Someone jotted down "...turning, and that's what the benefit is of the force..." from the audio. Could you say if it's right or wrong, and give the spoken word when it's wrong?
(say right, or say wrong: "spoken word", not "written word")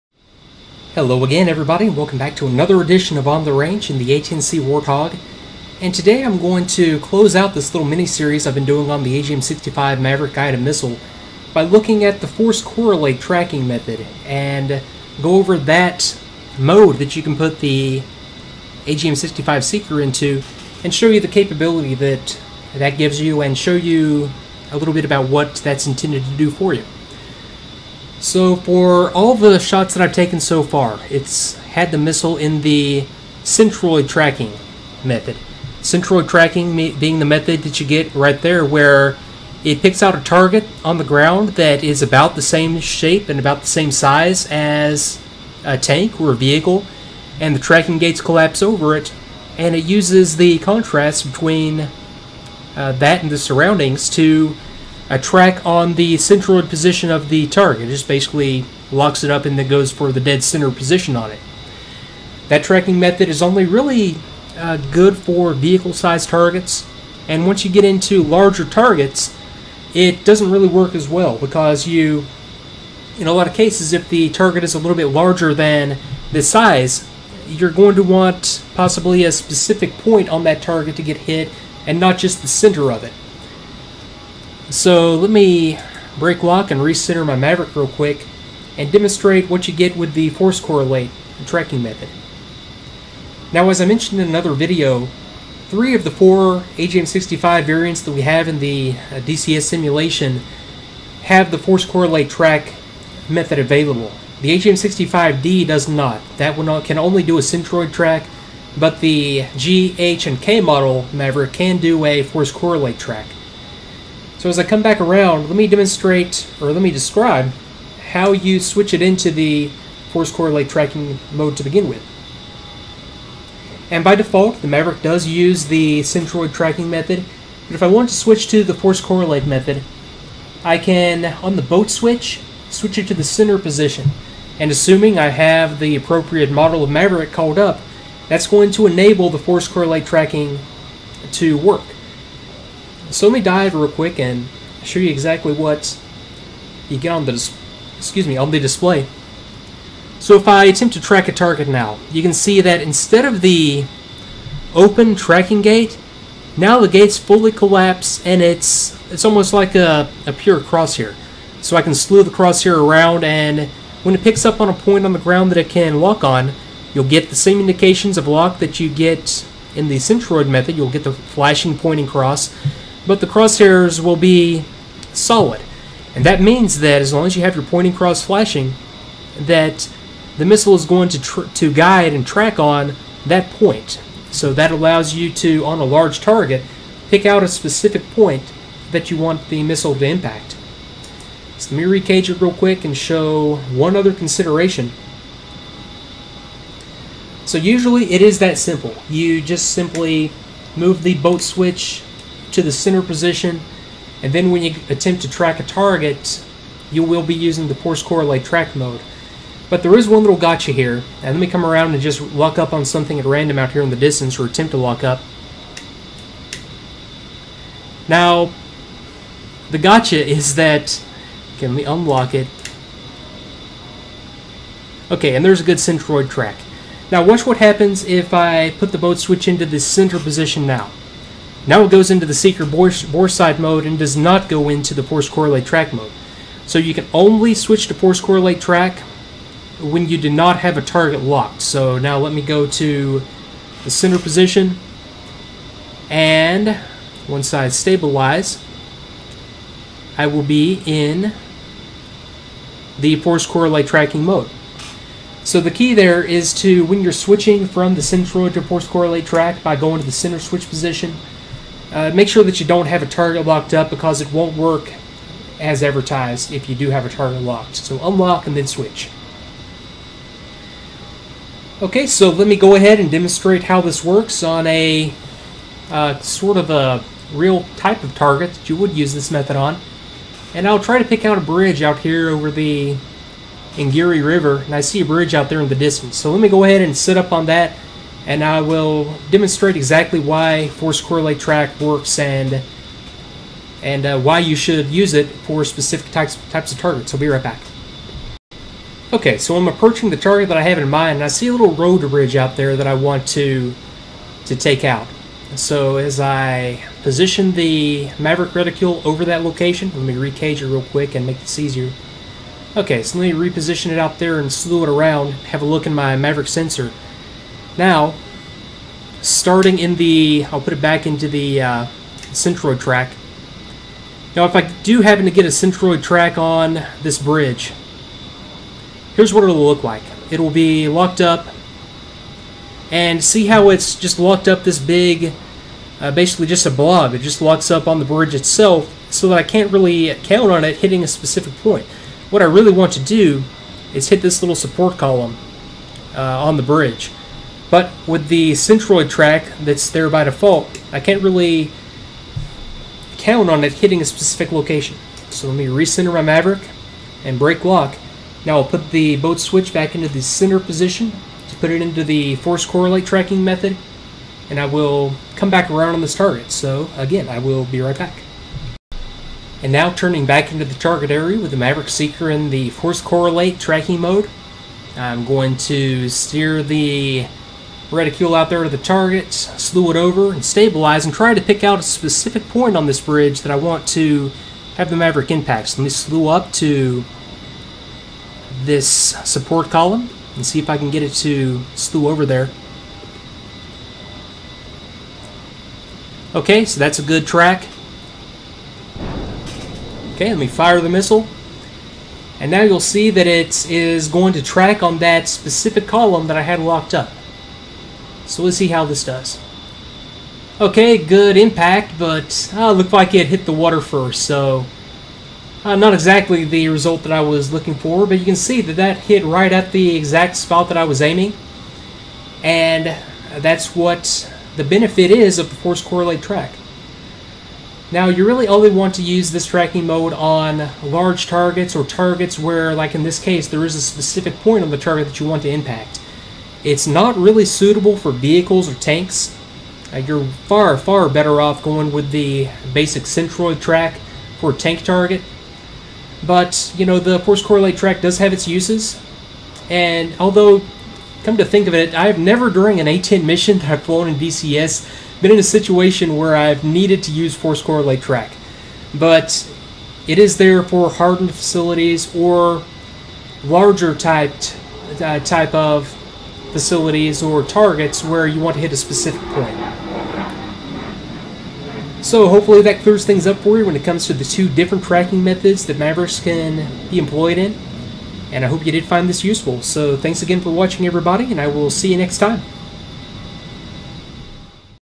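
wrong: "aiming", not "turning".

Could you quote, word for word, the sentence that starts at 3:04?
So that allows you to, on a large target, pick out a specific point that you want the missile to impact.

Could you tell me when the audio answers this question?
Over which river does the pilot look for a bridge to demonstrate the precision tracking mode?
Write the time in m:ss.
4:43.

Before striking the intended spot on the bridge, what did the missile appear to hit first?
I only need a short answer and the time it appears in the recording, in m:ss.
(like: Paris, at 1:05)
The water, at 6:53.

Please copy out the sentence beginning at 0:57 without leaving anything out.
It just basically locks it up and then goes for the dead center position on it.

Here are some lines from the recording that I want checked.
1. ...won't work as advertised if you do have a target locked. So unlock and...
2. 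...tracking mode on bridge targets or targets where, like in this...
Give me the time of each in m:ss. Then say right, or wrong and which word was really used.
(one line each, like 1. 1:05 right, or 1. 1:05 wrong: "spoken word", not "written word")
1. 4:24 right
2. 7:09 wrong: "large", not "bridge".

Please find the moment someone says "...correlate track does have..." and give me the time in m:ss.
7:27.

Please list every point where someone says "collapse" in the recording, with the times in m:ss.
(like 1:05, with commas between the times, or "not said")
0:48, 2:37.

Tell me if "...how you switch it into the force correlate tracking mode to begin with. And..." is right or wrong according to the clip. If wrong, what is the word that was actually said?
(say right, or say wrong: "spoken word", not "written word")
right.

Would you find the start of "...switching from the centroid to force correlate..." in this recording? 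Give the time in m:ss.
4:17.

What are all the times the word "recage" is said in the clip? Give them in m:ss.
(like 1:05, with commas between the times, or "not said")
3:11, 5:10.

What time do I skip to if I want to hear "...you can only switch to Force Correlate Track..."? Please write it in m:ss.
3:56.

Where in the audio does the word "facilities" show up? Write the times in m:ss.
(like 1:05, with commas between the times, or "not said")
7:41, 7:46.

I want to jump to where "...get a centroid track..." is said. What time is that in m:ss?
5:25.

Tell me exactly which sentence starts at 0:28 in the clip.
So for all the shots that I've taken so far, it's had the missile in the centroid tracking method.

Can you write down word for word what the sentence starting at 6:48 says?
So let's see how this does.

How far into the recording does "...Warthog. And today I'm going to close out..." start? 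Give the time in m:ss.
0:04.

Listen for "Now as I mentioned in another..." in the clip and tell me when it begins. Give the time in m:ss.
1:33.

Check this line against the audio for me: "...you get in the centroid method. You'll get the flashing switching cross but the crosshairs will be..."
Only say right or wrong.
wrong.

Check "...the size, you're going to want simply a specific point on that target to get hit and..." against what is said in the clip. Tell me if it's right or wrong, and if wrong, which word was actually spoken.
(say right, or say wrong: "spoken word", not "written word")
wrong: "possibly", not "simply".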